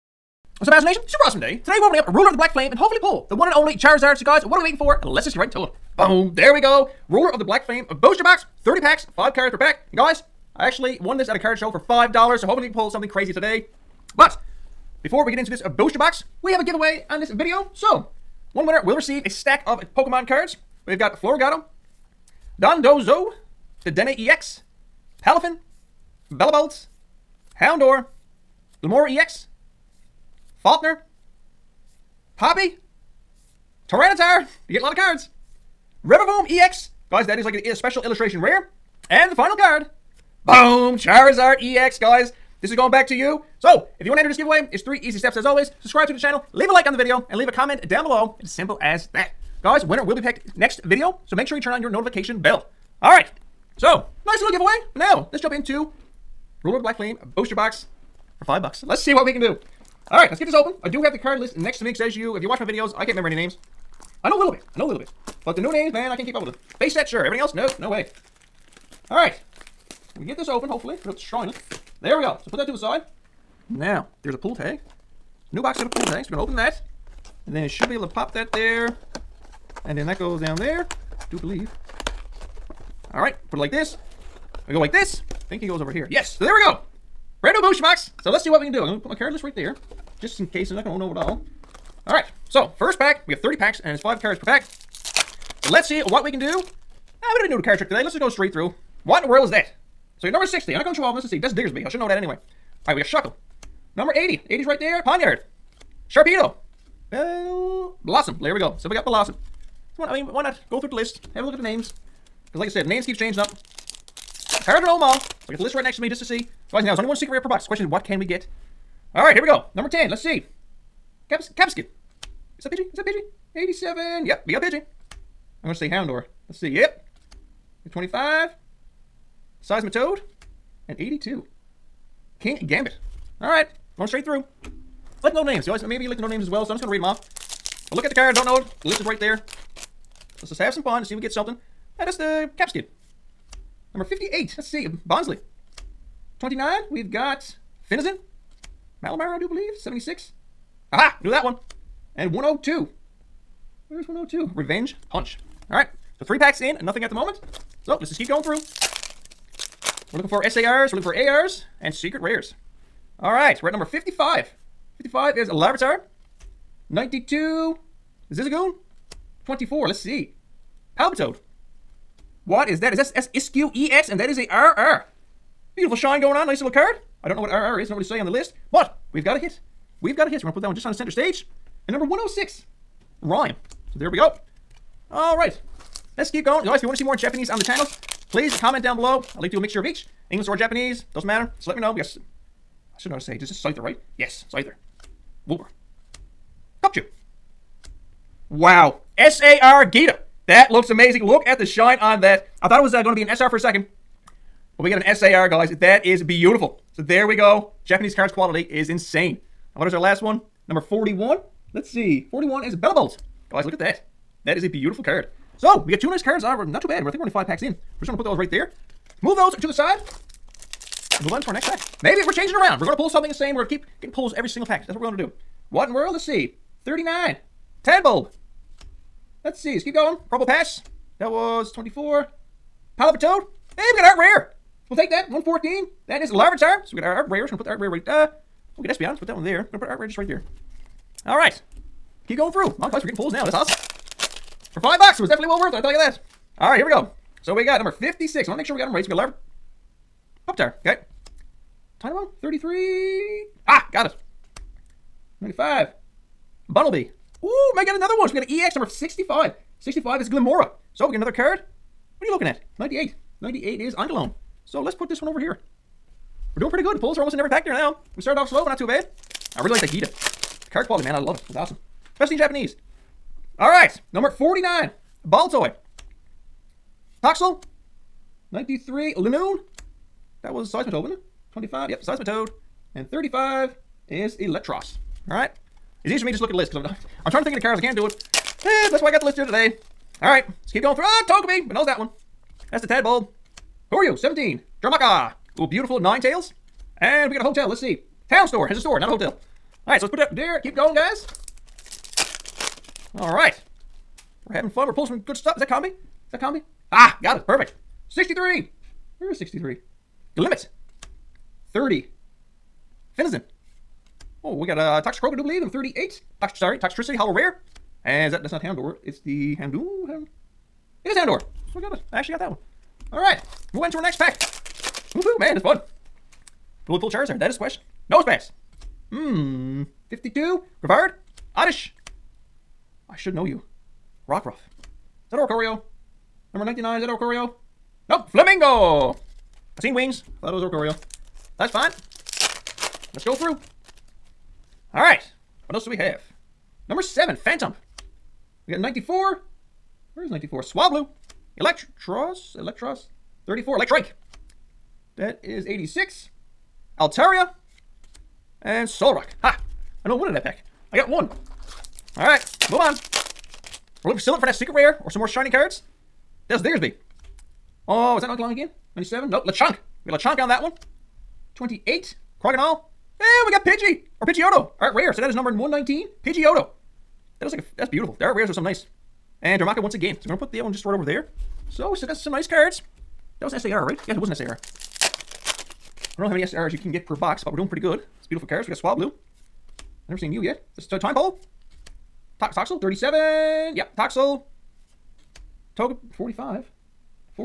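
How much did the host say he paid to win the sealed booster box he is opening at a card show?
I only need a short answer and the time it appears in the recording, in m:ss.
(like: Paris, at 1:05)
$5, at 0:11.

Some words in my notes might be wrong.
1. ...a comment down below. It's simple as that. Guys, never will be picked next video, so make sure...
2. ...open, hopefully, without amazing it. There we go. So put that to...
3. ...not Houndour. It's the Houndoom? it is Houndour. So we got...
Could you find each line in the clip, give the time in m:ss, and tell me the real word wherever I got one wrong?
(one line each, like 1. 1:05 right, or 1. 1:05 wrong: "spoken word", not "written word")
1. 0:47 wrong: "winner", not "never"
2. 1:10 wrong: "destroying", not "amazing"
3. 5:18 right.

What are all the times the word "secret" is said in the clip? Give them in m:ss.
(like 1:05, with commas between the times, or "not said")
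1:57, 2:41, 6:04.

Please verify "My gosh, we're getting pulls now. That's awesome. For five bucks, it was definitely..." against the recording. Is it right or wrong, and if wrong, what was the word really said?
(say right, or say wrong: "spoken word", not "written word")
right.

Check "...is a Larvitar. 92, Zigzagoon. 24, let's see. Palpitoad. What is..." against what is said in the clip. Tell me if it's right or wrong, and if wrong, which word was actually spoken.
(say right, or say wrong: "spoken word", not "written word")
right.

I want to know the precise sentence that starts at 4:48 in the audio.
Eh, that's why I got the list here today.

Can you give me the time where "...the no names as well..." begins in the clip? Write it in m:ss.
2:16.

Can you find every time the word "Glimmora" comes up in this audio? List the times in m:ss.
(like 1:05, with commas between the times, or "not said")
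0:28, 4:20.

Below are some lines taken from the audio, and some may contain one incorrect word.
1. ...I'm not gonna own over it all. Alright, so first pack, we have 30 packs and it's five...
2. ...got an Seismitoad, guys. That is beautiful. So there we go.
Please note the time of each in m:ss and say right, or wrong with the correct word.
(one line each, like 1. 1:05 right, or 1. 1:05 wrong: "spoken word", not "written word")
1. 1:30 right
2. 3:24 wrong: "SAR", not "Seismitoad".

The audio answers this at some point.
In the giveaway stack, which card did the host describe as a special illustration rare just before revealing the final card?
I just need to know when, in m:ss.
0:36.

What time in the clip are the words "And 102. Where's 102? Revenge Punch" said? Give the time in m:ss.
2:32.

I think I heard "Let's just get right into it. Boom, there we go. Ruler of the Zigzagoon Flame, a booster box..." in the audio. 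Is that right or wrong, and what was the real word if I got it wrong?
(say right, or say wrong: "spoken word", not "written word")
wrong: "Black", not "Zigzagoon".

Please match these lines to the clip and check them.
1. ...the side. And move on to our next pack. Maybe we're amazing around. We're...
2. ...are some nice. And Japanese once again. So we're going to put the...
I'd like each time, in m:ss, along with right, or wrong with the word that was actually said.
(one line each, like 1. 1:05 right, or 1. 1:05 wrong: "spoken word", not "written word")
1. 3:39 wrong: "changing", not "amazing"
2. 6:18 wrong: "Darumaka", not "Japanese".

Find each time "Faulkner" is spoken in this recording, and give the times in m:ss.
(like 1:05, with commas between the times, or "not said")
0:30.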